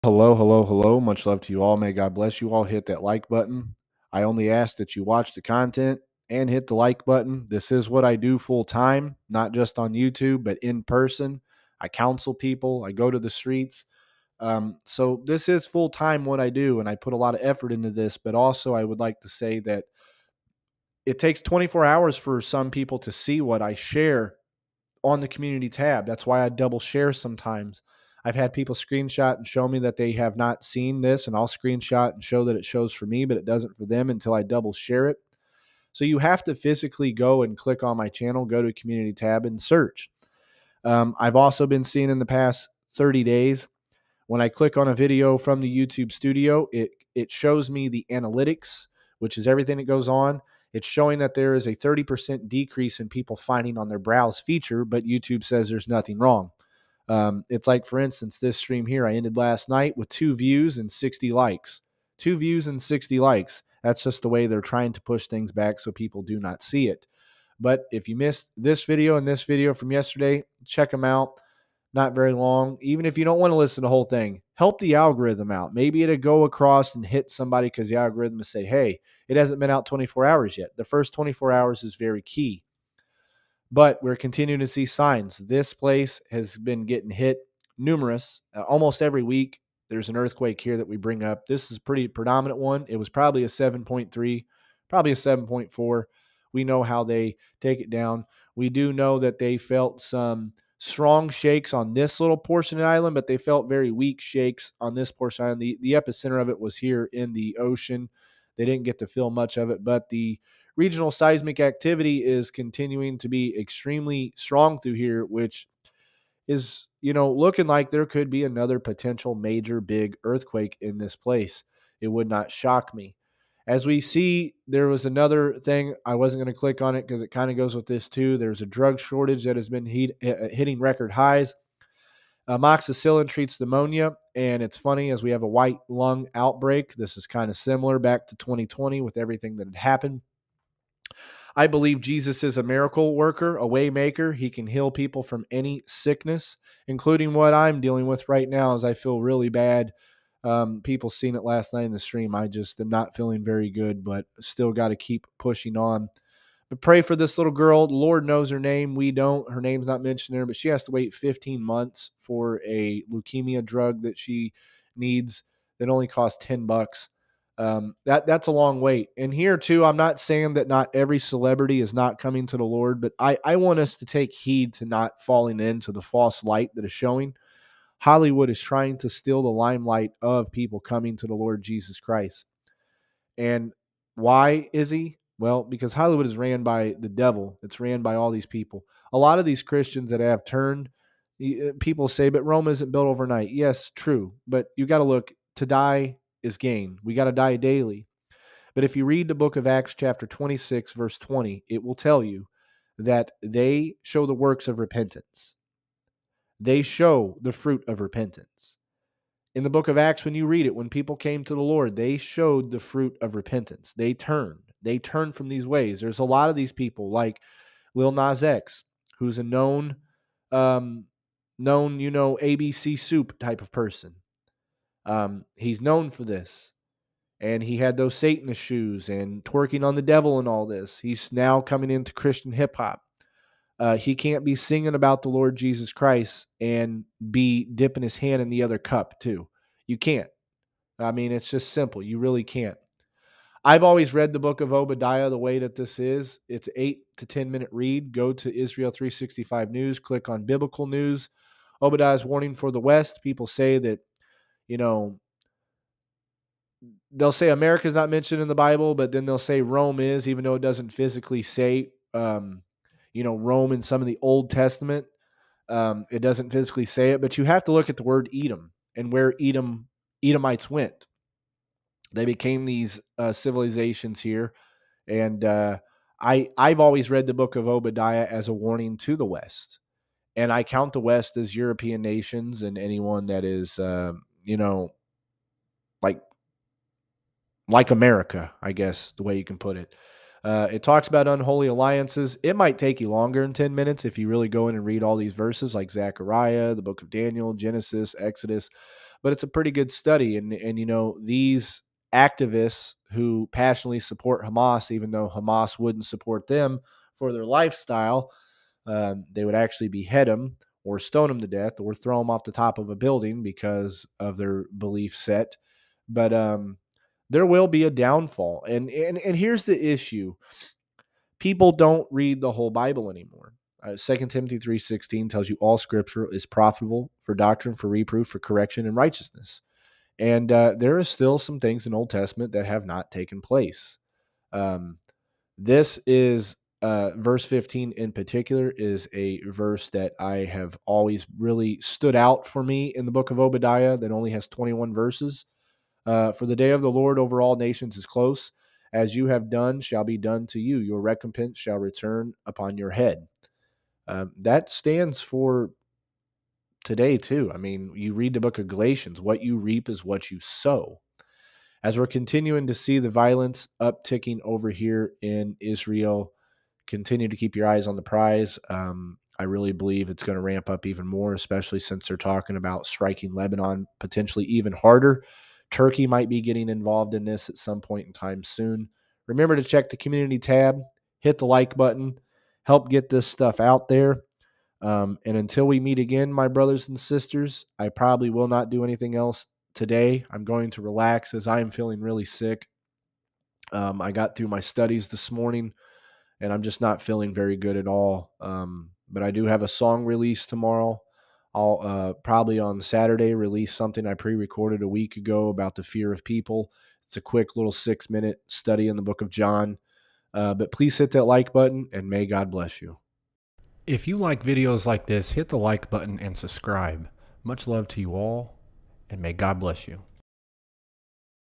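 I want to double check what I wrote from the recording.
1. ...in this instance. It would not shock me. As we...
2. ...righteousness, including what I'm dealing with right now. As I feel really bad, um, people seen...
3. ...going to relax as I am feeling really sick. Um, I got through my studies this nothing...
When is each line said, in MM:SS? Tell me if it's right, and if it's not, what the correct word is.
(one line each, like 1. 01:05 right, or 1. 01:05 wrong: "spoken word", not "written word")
1. 02:00 wrong: "place", not "instance"
2. 02:25 wrong: "sickness", not "righteousness"
3. 06:30 wrong: "morning", not "nothing".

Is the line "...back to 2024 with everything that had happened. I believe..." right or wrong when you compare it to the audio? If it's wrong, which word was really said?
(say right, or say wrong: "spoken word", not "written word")
wrong: "2020", not "2024".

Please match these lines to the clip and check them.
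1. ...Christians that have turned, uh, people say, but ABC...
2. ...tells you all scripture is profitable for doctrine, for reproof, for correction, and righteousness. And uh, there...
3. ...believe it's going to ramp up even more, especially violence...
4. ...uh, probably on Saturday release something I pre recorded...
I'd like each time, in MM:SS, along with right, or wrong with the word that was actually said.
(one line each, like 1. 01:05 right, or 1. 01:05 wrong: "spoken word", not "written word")
1. 03:09 wrong: "Rome", not "ABC"
2. 05:25 right
3. 06:09 wrong: "since", not "violence"
4. 06:41 right.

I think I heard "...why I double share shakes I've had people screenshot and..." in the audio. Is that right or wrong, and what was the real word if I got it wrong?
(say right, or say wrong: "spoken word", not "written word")
wrong: "sometimes", not "shakes".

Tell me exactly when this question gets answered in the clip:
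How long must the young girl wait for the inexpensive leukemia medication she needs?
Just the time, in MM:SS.
02:41.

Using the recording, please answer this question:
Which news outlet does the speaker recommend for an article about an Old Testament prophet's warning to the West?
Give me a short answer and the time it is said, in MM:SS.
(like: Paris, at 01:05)
Israel 365 News, at 04:08.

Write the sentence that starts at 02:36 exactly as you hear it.
But pray for this little girl.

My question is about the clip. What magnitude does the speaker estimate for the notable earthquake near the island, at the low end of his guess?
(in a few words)
7.3.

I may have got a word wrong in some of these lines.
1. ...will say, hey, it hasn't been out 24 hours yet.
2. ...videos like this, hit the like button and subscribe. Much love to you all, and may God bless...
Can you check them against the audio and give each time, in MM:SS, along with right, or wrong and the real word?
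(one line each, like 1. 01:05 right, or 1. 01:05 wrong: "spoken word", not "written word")
1. 01:18 right
2. 06:54 right.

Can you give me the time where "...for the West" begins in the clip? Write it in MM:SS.
04:12.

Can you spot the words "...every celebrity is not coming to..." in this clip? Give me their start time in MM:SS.
02:50.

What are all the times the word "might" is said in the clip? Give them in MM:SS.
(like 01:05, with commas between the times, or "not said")
04:52, 06:16.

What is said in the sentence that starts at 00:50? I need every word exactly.
It's showing that there is a 30% decrease in people finding on their browse feature, but YouTube says there's nothing wrong.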